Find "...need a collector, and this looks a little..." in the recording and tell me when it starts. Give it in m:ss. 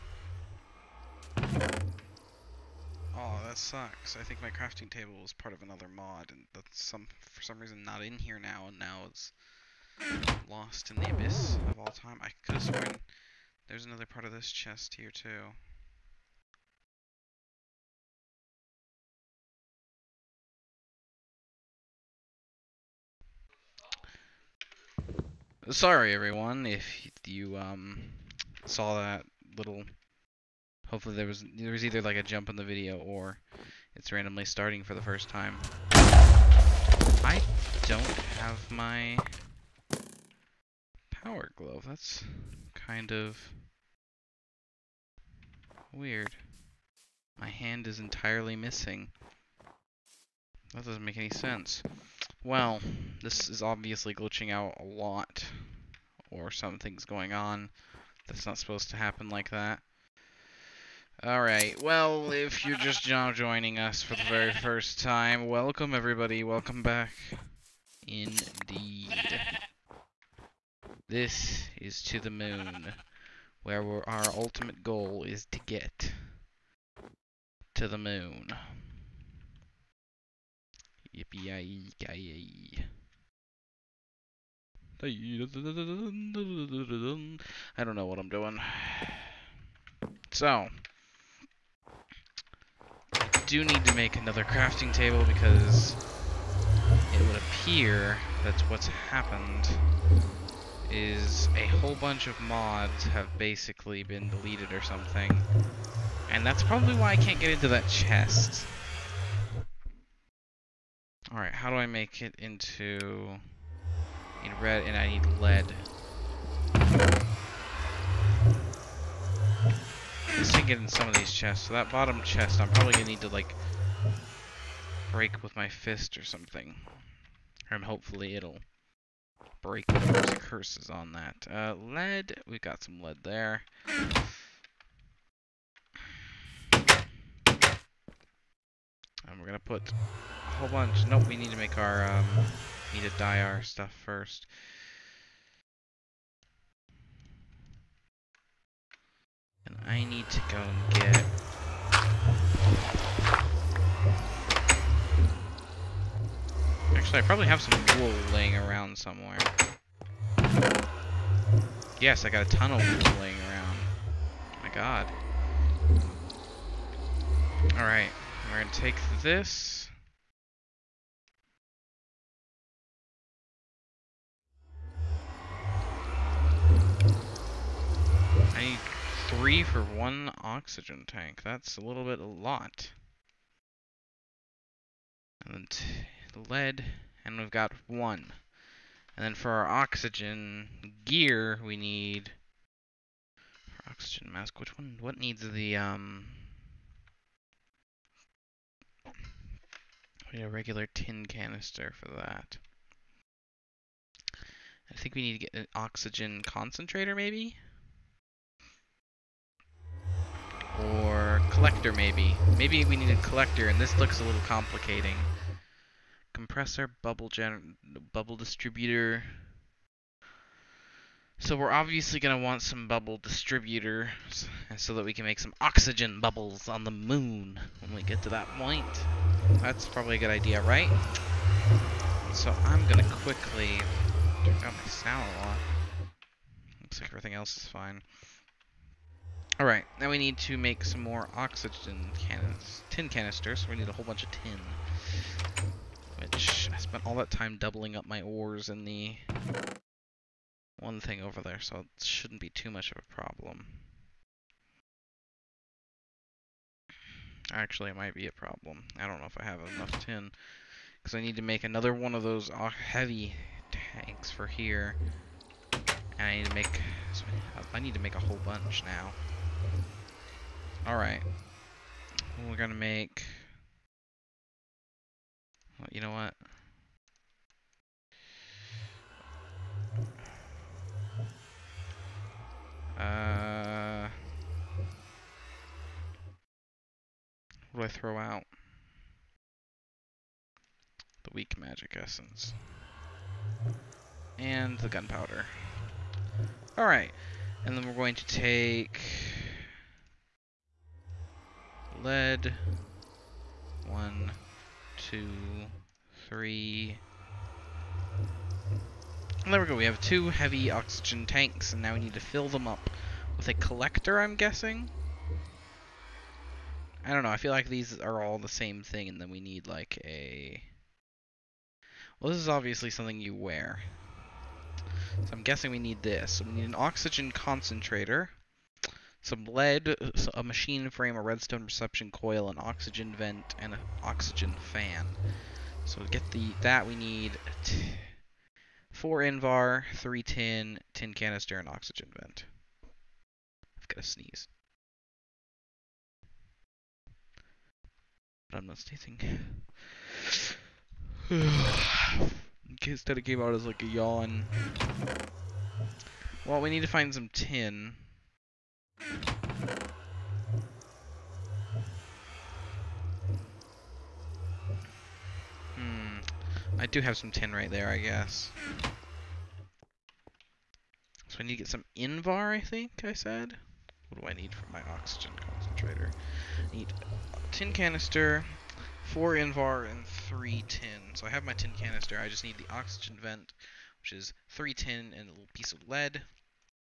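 3:32.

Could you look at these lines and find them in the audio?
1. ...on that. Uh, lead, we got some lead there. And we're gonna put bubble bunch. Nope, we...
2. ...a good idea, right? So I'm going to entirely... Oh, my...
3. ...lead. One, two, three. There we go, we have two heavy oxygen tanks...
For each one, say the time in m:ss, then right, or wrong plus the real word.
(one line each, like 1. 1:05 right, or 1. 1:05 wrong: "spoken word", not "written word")
1. 2:10 wrong: "whole", not "bubble"
2. 3:50 wrong: "quickly", not "entirely"
3. 5:02 right.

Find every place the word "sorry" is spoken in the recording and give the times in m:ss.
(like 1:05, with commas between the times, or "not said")
0:25.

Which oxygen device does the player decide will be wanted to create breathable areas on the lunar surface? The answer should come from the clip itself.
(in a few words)
Bubble distributor.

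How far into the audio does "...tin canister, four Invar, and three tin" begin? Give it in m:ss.
6:17.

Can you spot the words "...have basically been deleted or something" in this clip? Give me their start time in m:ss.
1:43.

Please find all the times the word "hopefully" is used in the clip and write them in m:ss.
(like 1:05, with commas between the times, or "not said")
0:30, 2:07.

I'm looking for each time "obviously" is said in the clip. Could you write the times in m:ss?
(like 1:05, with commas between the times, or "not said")
0:53, 3:41, 5:22.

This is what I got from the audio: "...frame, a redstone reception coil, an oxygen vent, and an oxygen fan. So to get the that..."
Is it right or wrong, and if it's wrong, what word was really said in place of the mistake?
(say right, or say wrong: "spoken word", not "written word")
right.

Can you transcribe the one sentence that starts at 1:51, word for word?
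All right, how do I make it into in red and I need lead.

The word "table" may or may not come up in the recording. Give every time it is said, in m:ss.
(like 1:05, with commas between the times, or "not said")
0:04, 1:34.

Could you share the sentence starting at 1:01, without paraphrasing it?
Alright, well, if you're just now joining us for the very first time, welcome everybody, welcome back.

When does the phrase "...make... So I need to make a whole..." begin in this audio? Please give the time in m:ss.
4:26.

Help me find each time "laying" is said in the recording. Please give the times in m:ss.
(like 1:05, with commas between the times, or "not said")
2:38, 2:43.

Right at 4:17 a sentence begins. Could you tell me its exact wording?
Actually, it might be a problem.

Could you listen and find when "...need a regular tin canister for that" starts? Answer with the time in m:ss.
3:20.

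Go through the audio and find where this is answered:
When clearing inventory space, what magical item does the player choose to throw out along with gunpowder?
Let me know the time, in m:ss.
4:51.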